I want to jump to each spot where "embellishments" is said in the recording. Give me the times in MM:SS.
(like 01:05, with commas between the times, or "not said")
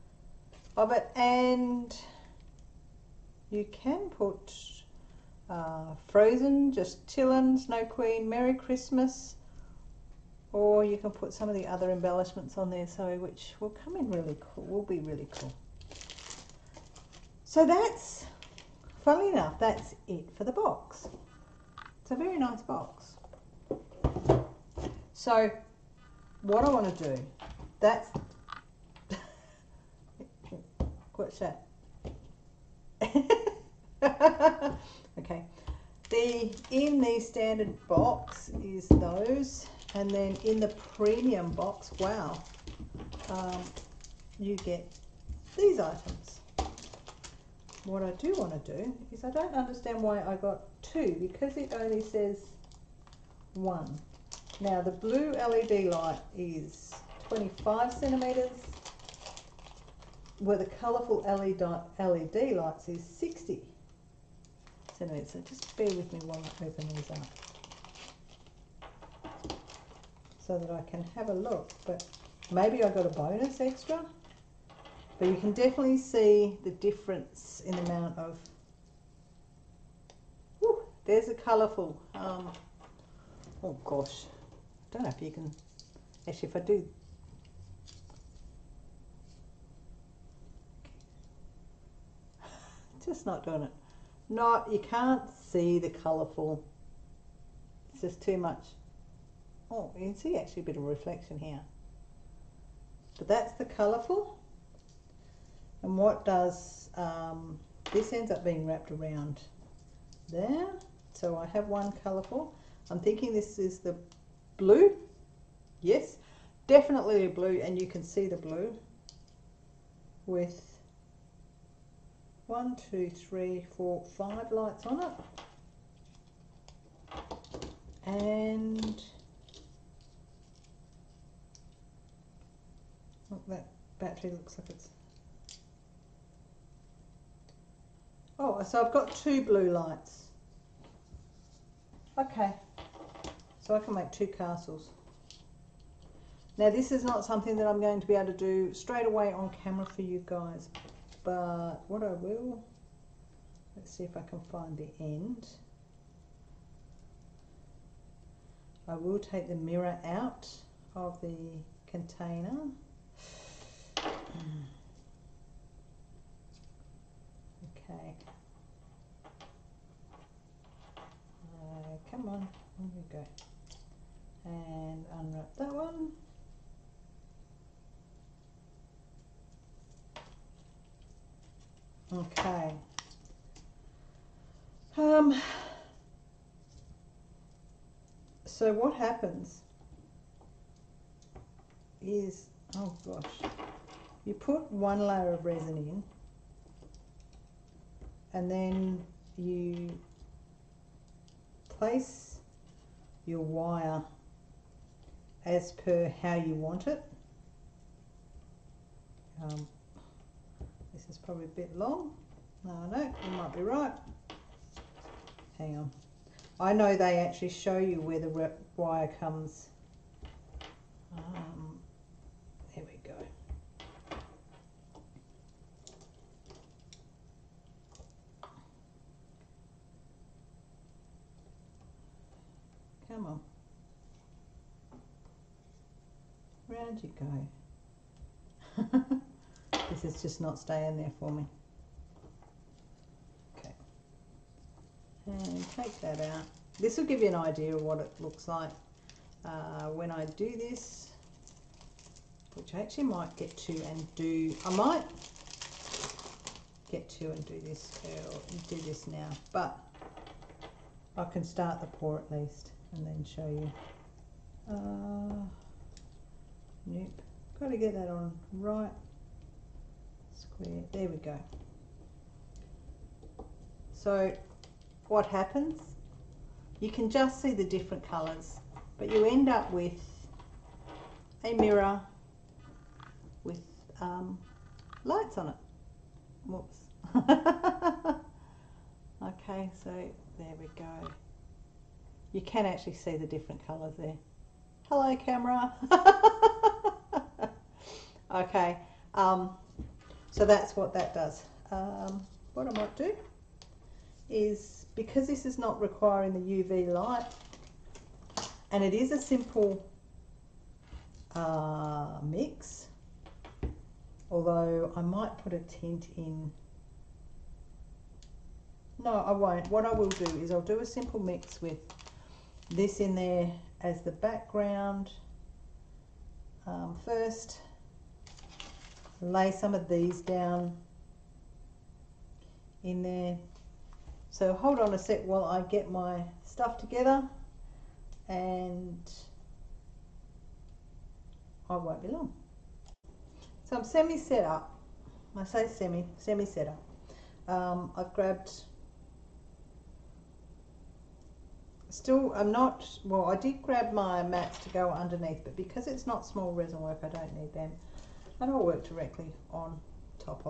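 00:11.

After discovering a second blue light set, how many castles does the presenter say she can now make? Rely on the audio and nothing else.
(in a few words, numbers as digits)
2.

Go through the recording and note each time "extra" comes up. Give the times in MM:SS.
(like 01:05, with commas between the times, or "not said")
01:13.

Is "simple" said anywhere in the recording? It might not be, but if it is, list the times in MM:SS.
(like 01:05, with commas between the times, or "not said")
05:09, 05:20.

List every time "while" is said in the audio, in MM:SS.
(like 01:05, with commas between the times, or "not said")
01:06, 05:35.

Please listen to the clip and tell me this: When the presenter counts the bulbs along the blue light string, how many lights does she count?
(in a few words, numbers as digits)
5.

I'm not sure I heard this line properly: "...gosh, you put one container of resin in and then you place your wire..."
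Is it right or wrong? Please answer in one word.
wrong.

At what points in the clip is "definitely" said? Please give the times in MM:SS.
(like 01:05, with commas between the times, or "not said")
01:15, 01:56.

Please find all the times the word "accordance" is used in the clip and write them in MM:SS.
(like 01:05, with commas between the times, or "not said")
not said.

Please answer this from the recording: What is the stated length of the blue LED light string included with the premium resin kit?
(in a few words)
25 centimeters.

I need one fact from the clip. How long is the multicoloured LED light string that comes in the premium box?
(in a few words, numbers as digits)
60 centimetres.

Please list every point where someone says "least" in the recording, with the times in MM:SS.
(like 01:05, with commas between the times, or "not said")
04:22.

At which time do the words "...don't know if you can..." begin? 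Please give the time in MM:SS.
01:24.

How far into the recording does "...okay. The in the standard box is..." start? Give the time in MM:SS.
00:35.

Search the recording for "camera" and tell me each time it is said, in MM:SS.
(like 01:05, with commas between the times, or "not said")
02:29, 04:55.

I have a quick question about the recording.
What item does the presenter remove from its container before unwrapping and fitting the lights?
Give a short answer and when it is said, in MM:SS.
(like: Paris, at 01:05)
The mirror, at 02:39.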